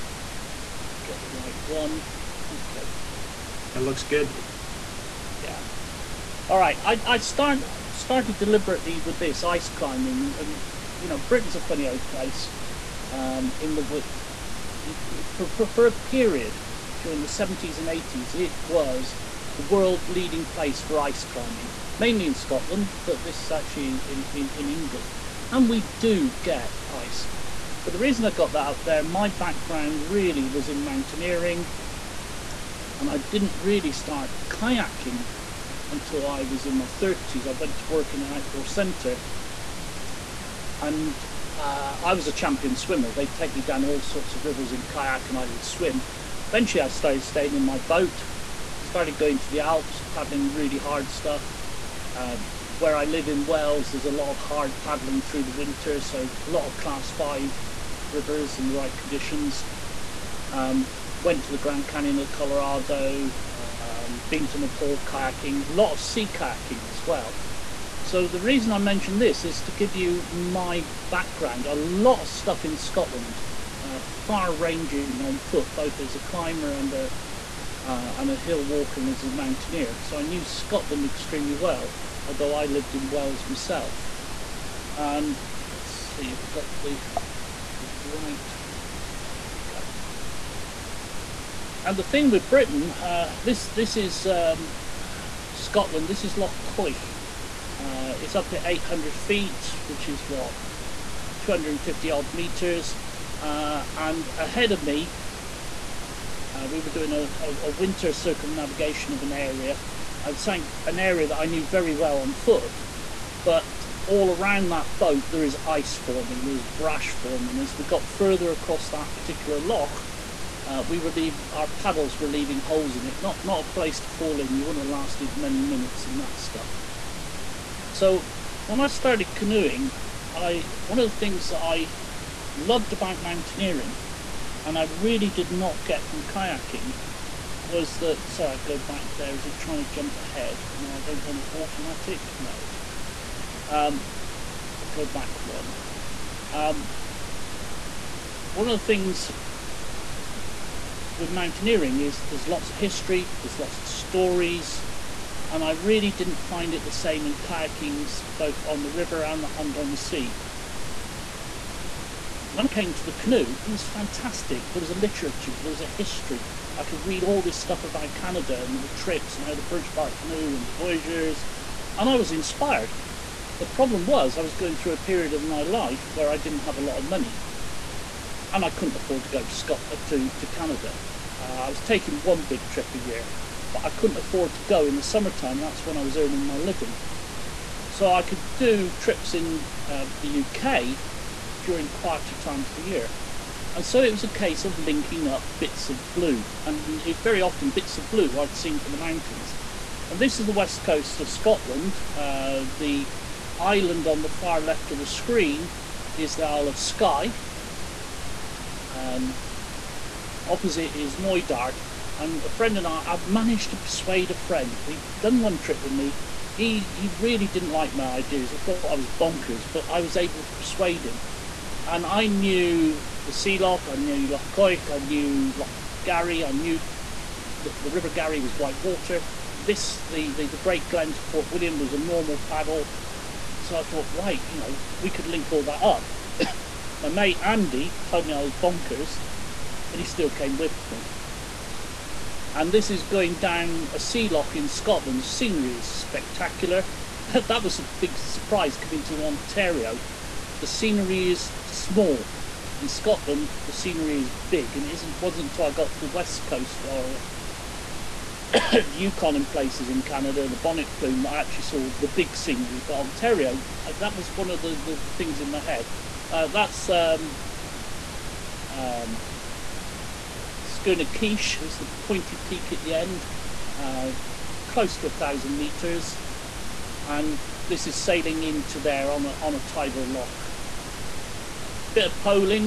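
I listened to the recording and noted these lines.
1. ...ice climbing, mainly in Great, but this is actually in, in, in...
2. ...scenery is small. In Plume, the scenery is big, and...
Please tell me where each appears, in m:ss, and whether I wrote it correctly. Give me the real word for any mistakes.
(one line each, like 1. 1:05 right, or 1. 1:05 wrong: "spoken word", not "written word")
1. 0:20 wrong: "Scotland", not "Great"
2. 4:10 wrong: "Scotland", not "Plume".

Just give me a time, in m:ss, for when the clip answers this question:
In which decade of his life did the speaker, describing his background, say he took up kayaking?
0:36.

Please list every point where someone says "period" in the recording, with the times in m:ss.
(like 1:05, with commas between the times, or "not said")
0:15, 2:54.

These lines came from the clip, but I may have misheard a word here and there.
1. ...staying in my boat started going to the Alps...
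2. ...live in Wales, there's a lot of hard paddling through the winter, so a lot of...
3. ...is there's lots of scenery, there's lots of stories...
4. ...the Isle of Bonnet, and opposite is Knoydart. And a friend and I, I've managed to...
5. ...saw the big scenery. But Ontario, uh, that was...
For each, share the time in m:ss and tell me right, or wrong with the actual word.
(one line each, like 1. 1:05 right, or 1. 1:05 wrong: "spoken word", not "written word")
1. 0:47 right
2. 0:53 right
3. 2:31 wrong: "history", not "scenery"
4. 3:26 wrong: "Skye", not "Bonnet"
5. 4:21 right.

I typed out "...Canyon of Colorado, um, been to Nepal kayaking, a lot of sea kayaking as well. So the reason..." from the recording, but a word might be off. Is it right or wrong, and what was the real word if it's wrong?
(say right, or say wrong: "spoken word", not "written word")
right.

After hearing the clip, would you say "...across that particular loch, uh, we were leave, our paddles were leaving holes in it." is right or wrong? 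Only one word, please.
right.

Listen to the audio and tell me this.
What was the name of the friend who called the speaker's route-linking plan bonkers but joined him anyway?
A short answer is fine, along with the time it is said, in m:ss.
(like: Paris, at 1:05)
Andy, at 3:57.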